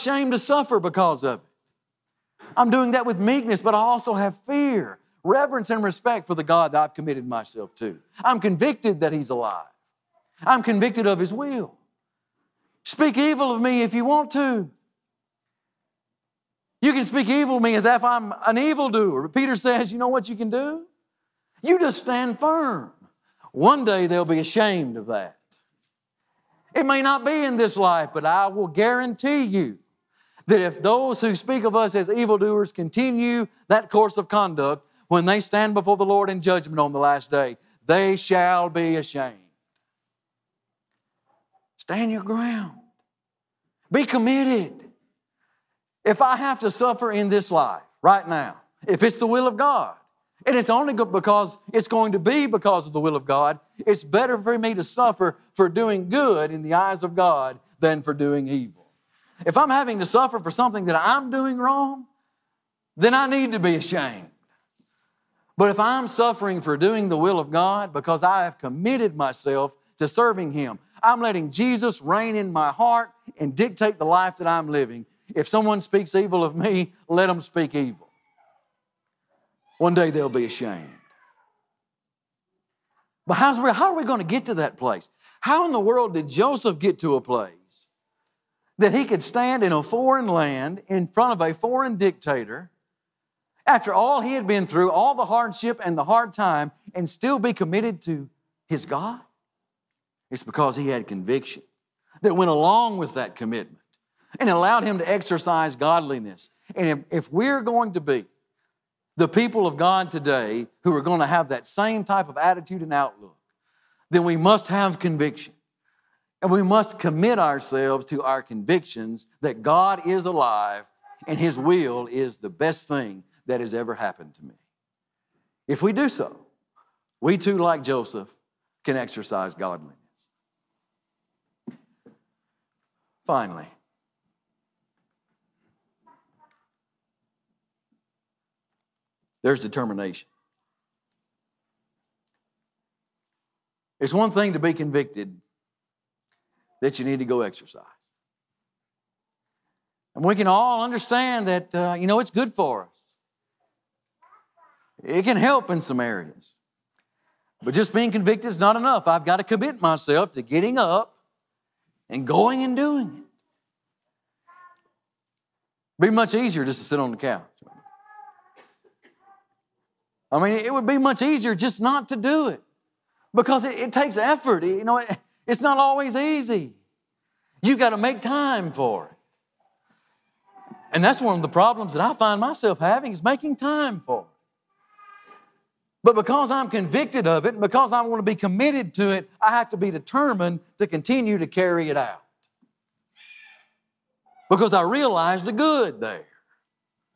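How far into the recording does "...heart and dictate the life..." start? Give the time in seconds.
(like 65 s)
72 s.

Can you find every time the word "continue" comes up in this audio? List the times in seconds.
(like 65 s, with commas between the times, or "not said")
32 s, 190 s.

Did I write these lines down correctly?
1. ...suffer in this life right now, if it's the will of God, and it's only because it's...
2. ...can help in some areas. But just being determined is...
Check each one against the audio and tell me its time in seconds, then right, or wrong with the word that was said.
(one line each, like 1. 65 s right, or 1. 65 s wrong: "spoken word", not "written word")
1. 46 s right
2. 155 s wrong: "convicted", not "determined".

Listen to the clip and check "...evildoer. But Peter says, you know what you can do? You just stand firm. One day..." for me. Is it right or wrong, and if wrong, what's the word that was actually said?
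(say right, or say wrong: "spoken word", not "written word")
right.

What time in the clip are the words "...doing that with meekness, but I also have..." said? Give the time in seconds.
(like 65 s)
2 s.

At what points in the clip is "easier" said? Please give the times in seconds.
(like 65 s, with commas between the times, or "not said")
166 s, 171 s.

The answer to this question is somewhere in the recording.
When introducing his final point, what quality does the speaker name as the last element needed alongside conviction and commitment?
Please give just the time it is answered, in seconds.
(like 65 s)
139 s.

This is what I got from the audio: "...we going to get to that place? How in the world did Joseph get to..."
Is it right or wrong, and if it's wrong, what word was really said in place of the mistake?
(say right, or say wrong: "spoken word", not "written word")
right.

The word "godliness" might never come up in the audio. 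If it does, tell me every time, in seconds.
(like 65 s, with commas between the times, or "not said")
105 s, 129 s.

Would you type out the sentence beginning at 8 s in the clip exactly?
I'm convicted that He's alive, I'm convicted of His will.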